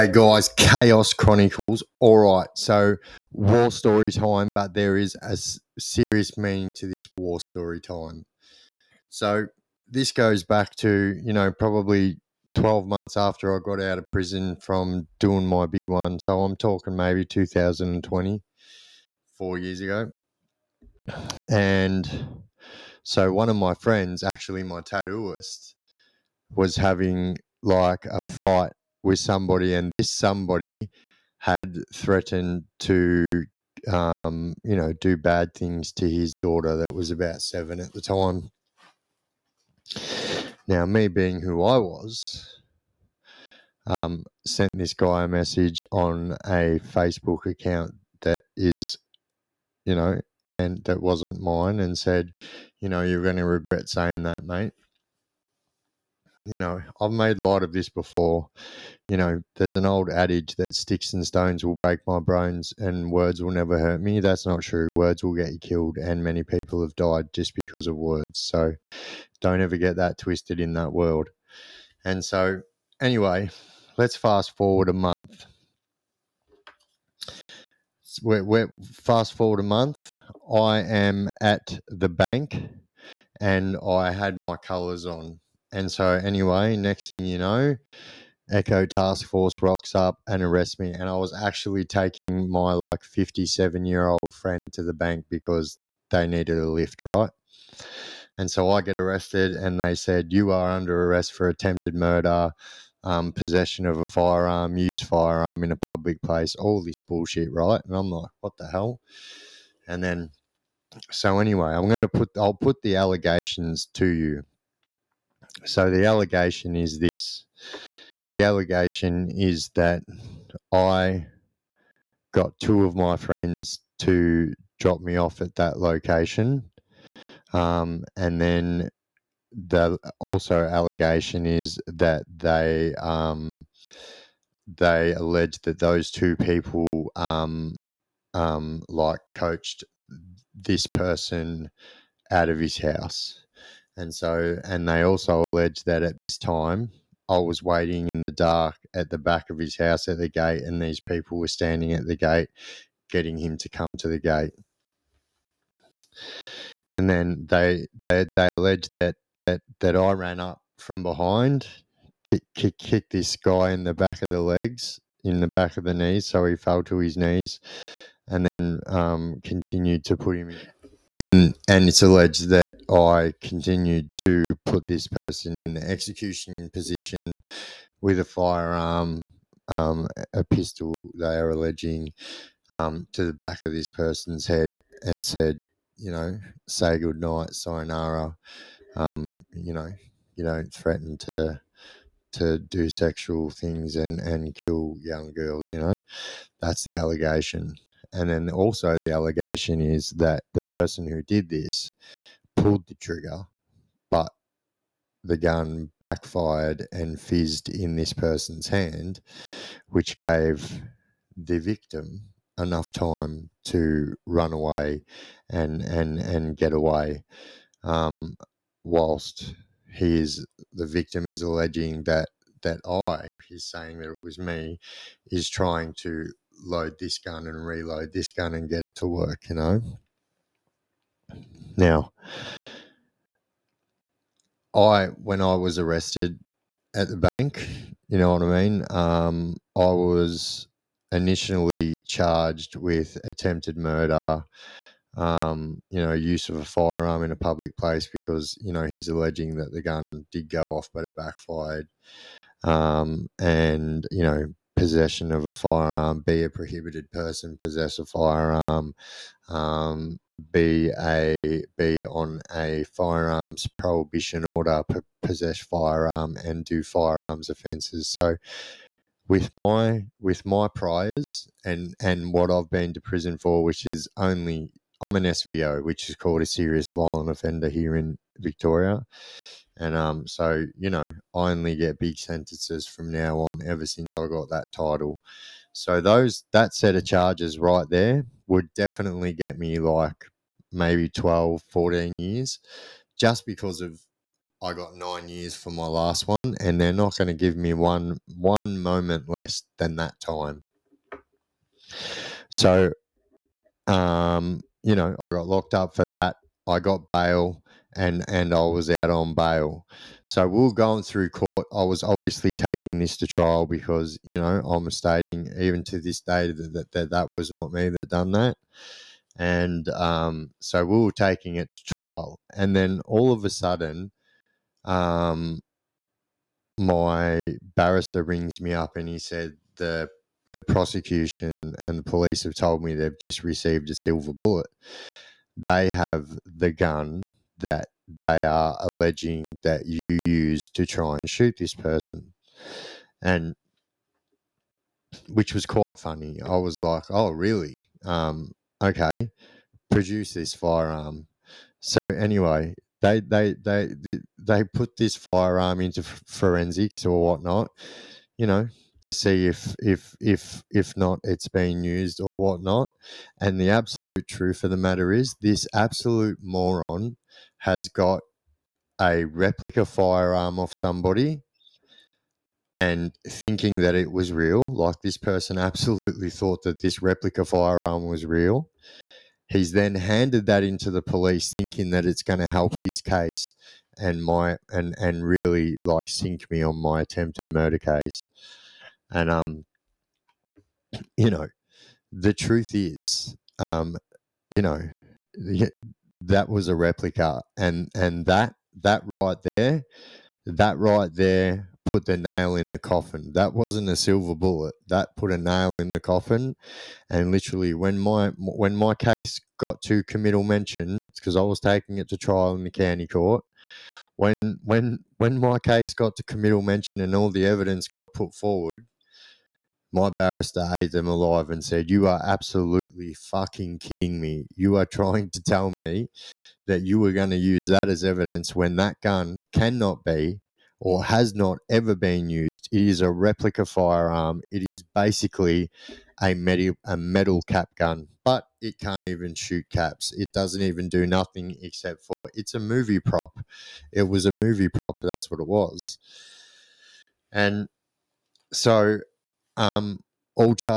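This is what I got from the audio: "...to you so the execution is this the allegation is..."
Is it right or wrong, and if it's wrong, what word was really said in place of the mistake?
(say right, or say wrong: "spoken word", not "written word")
wrong: "allegation", not "execution".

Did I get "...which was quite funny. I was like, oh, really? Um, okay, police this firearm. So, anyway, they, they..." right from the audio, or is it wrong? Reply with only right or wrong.
wrong.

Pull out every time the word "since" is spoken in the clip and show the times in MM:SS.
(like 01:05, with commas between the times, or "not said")
04:43.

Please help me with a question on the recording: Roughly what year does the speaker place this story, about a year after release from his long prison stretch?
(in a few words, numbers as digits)
2020.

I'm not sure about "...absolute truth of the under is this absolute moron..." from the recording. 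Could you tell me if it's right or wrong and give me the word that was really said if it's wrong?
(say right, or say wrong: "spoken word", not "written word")
wrong: "matter", not "under".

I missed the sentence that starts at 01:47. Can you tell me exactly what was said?
And I'm like, What the hell?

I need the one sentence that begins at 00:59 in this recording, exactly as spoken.
You know, there's an old adage that sticks and stones will break my bones and words will never hurt me.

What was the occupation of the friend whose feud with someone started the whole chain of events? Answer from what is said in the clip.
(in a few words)
Tattooist.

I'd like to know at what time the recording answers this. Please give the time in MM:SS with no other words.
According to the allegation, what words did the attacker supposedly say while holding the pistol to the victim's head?
03:06.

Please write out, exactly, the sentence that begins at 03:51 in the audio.
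Now, I when I was arrested at the bank, you know what I mean.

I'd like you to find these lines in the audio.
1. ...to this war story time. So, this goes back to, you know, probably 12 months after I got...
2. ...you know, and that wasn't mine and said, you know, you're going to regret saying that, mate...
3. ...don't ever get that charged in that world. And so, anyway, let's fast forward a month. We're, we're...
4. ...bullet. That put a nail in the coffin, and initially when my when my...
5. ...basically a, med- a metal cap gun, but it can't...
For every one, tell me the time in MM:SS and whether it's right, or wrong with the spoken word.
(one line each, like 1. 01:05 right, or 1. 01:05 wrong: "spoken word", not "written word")
1. 00:06 right
2. 00:49 right
3. 01:09 wrong: "twisted", not "charged"
4. 06:44 wrong: "literally", not "initially"
5. 07:14 right.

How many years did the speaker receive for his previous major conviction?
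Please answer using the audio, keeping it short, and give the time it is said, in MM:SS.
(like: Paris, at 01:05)
9 years, at 04:54.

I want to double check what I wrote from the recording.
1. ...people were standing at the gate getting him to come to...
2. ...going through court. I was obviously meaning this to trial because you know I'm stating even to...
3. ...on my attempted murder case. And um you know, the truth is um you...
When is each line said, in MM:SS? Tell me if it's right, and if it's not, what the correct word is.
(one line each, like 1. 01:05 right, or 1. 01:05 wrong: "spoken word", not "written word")
1. 02:31 right
2. 05:10 wrong: "taking", not "meaning"
3. 06:26 right.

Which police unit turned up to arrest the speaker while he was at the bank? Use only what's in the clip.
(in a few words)
Echo Task Force.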